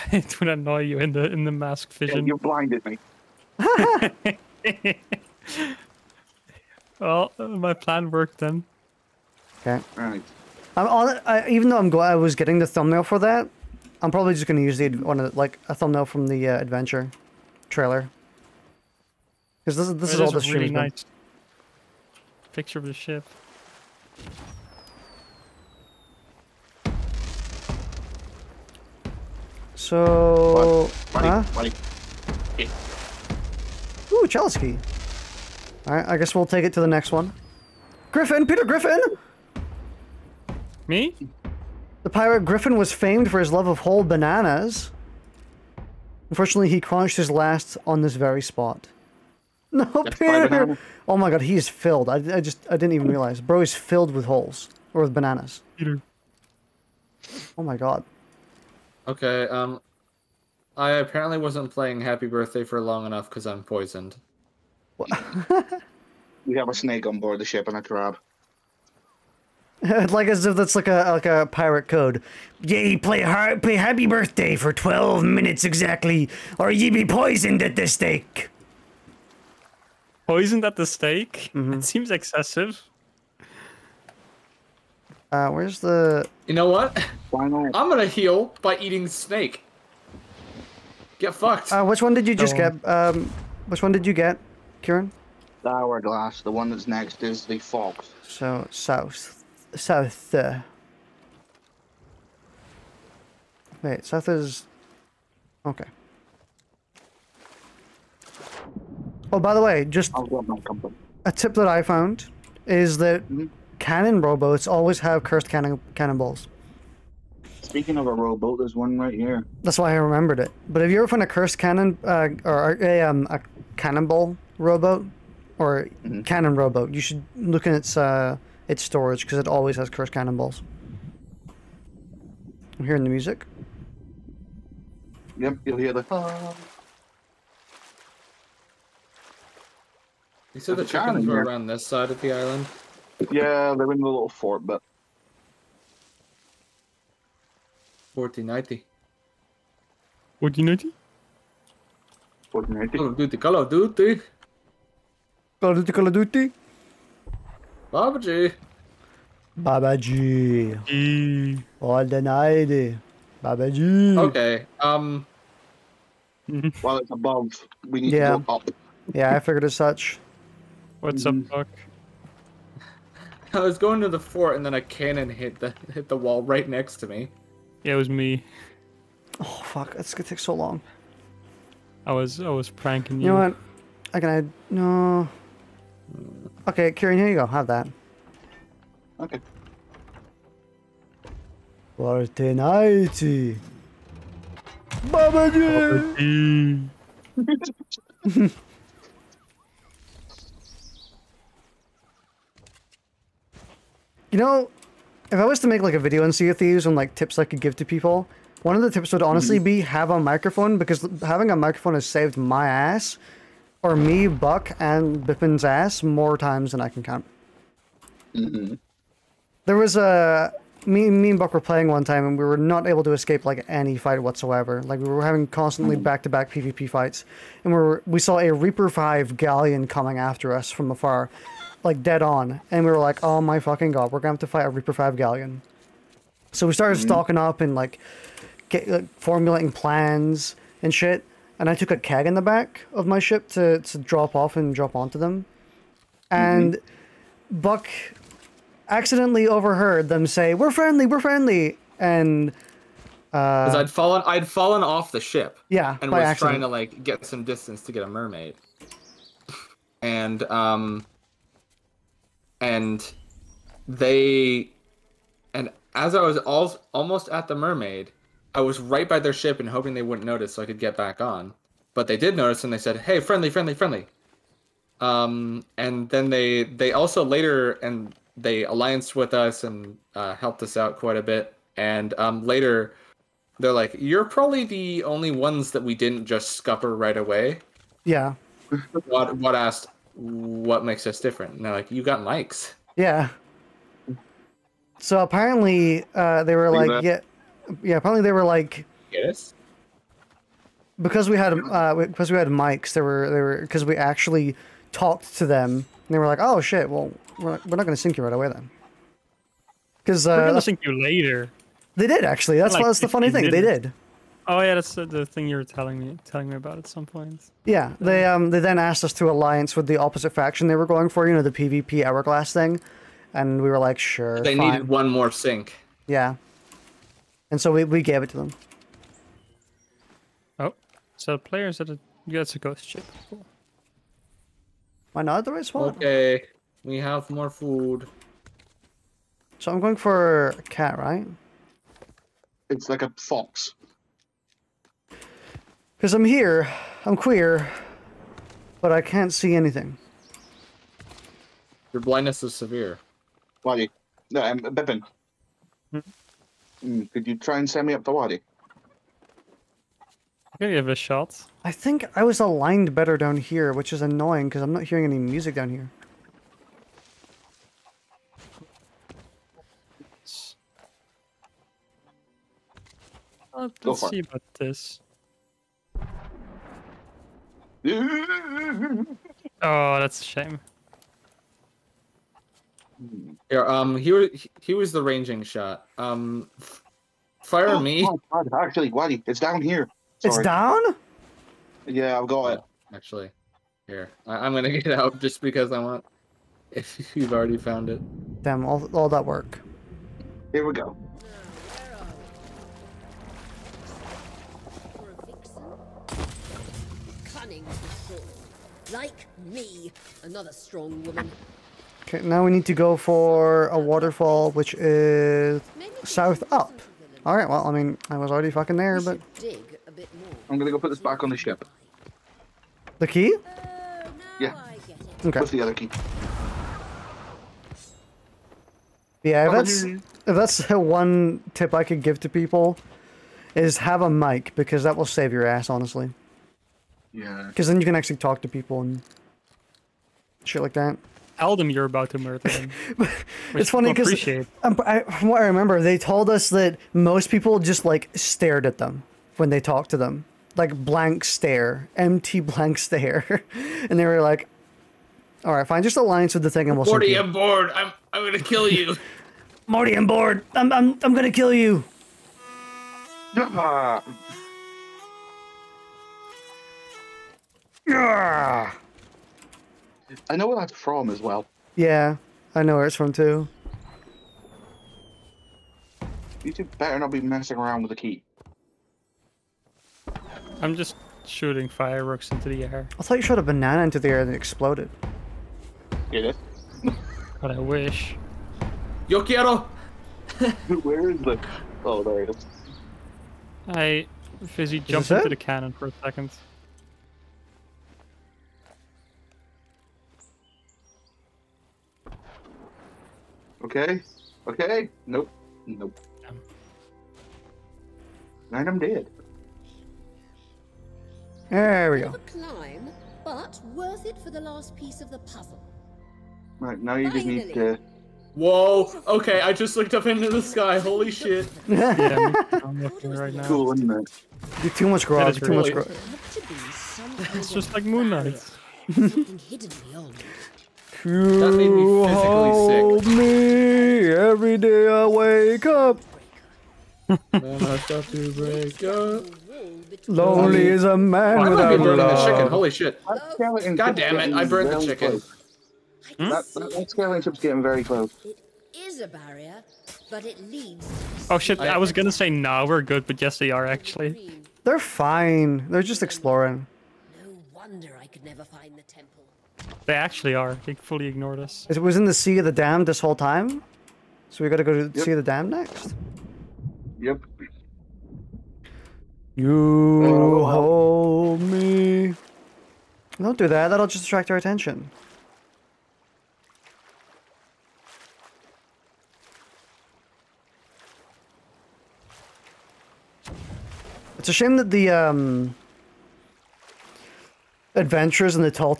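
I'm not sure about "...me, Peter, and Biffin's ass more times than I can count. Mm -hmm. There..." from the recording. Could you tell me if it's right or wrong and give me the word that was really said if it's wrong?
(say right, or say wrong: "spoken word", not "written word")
wrong: "Buck", not "Peter".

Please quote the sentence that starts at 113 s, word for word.
cannon rowboats always have cursed cannon cannonballs.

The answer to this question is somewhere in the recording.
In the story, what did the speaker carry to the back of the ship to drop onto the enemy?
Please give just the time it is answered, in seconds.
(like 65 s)
241 s.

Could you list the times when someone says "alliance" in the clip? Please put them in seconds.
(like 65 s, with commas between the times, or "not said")
278 s, 319 s, 455 s.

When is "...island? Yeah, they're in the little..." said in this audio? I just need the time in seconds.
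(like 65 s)
142 s.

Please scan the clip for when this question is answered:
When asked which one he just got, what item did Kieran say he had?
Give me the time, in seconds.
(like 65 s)
95 s.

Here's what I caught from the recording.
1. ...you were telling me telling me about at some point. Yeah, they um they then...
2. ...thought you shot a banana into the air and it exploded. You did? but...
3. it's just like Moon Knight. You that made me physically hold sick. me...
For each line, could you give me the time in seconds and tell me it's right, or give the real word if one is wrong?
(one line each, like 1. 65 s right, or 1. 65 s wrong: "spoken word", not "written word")
1. 315 s right
2. 483 s right
3. 527 s right.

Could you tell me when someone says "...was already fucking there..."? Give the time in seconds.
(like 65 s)
418 s.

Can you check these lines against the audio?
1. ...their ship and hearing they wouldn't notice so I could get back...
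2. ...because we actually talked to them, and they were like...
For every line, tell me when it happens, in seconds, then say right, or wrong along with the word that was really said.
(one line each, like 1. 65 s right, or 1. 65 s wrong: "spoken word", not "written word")
1. 269 s wrong: "hoping", not "hearing"
2. 303 s right.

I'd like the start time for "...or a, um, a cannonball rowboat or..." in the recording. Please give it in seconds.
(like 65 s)
122 s.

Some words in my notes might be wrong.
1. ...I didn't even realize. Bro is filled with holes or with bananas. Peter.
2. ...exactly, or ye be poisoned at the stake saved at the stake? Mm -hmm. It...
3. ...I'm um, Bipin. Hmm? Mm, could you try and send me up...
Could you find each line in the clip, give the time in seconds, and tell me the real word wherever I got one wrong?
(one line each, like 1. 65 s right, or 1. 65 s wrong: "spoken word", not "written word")
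1. 52 s right
2. 75 s wrong: "poisoned", not "saved"
3. 354 s right.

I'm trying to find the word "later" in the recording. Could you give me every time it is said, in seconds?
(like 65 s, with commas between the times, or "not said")
277 s, 282 s, 310 s.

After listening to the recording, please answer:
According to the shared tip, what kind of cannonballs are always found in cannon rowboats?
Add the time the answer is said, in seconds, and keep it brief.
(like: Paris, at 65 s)
Cursed cannonballs, at 129 s.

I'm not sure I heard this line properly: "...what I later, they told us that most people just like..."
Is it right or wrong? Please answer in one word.
wrong.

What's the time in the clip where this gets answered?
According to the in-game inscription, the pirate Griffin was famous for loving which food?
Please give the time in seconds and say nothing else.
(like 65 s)
43 s.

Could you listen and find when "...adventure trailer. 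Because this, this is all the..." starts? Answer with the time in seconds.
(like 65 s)
16 s.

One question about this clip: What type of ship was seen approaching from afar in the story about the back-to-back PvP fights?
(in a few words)
Reaper 5 galleon.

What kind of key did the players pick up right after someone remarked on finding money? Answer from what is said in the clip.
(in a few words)
Chalice key.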